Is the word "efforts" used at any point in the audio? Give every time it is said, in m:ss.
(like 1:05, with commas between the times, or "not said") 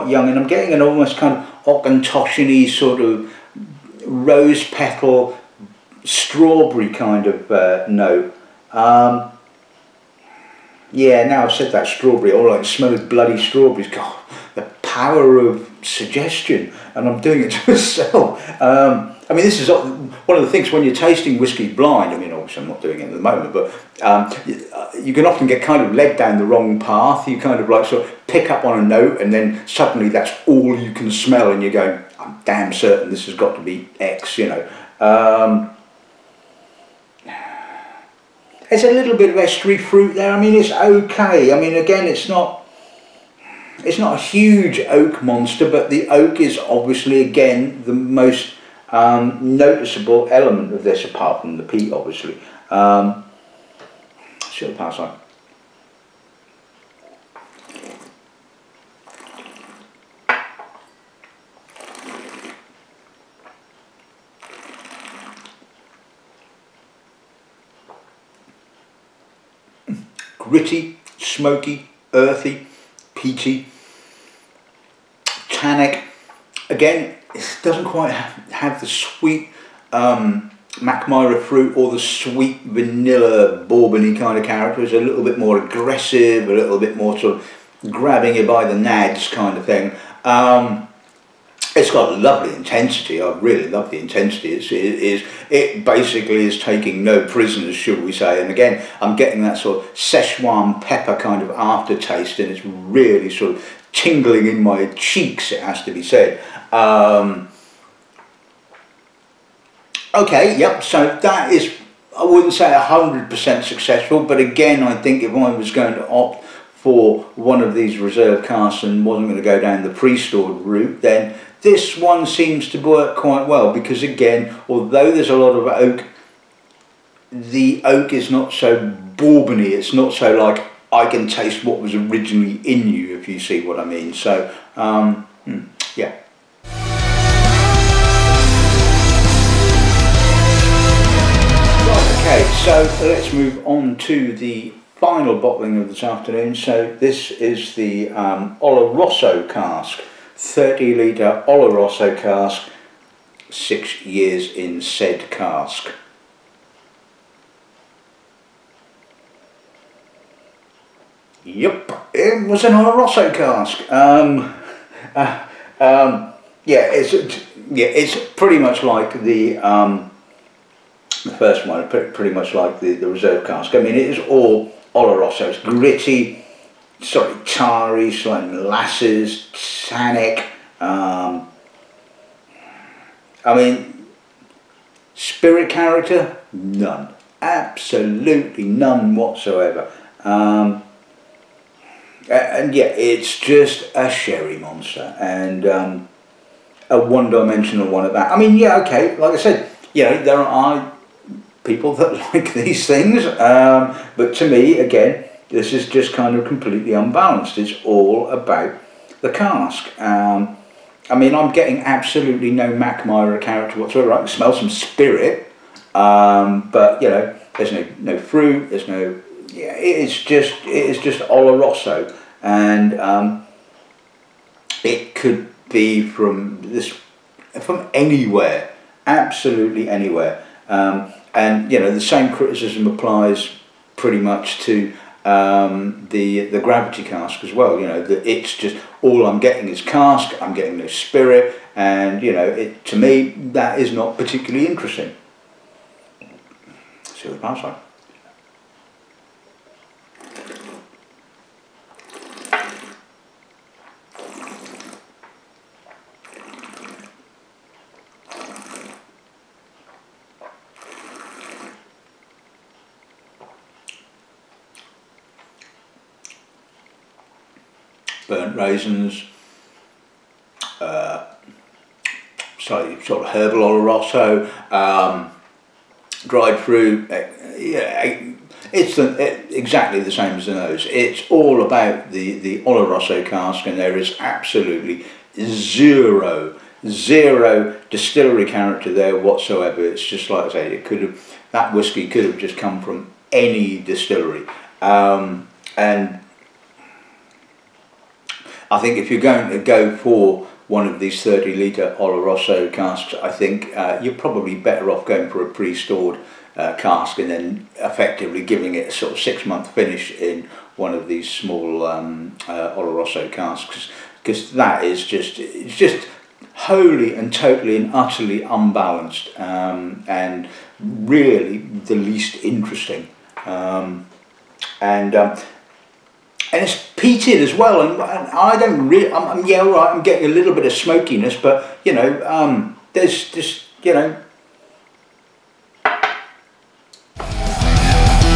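not said.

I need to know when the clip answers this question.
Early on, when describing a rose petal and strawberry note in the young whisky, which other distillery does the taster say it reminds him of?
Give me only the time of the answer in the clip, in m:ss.
0:01.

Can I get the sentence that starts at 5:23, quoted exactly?
Um, and um, and it's peated as well.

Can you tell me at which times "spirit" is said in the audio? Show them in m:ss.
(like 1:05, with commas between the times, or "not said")
3:05, 3:34, 4:00.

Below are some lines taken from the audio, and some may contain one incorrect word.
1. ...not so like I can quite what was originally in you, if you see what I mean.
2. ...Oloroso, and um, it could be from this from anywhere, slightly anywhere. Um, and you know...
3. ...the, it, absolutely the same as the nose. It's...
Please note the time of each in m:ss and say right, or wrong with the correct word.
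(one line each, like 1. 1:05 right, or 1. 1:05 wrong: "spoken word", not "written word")
1. 2:09 wrong: "taste", not "quite"
2. 3:41 wrong: "absolutely", not "slightly"
3. 4:38 wrong: "exactly", not "absolutely".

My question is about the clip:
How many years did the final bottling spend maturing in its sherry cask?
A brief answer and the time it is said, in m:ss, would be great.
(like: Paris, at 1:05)
6 years, at 2:33.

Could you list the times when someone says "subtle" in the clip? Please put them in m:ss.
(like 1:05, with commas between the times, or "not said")
not said.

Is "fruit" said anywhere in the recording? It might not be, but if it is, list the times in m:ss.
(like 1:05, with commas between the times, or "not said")
0:39, 1:21, 3:38, 4:36.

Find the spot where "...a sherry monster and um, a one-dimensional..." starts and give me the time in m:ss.
3:13.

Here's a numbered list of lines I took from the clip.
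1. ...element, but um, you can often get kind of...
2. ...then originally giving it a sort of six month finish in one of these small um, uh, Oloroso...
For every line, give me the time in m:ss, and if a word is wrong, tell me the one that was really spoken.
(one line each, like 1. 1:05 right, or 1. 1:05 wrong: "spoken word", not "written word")
1. 0:23 wrong: "moment", not "element"
2. 5:07 wrong: "effectively", not "originally".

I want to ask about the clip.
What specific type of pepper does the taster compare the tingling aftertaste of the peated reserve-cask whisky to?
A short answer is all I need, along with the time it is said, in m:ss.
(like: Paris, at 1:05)
Szechuan pepper, at 1:39.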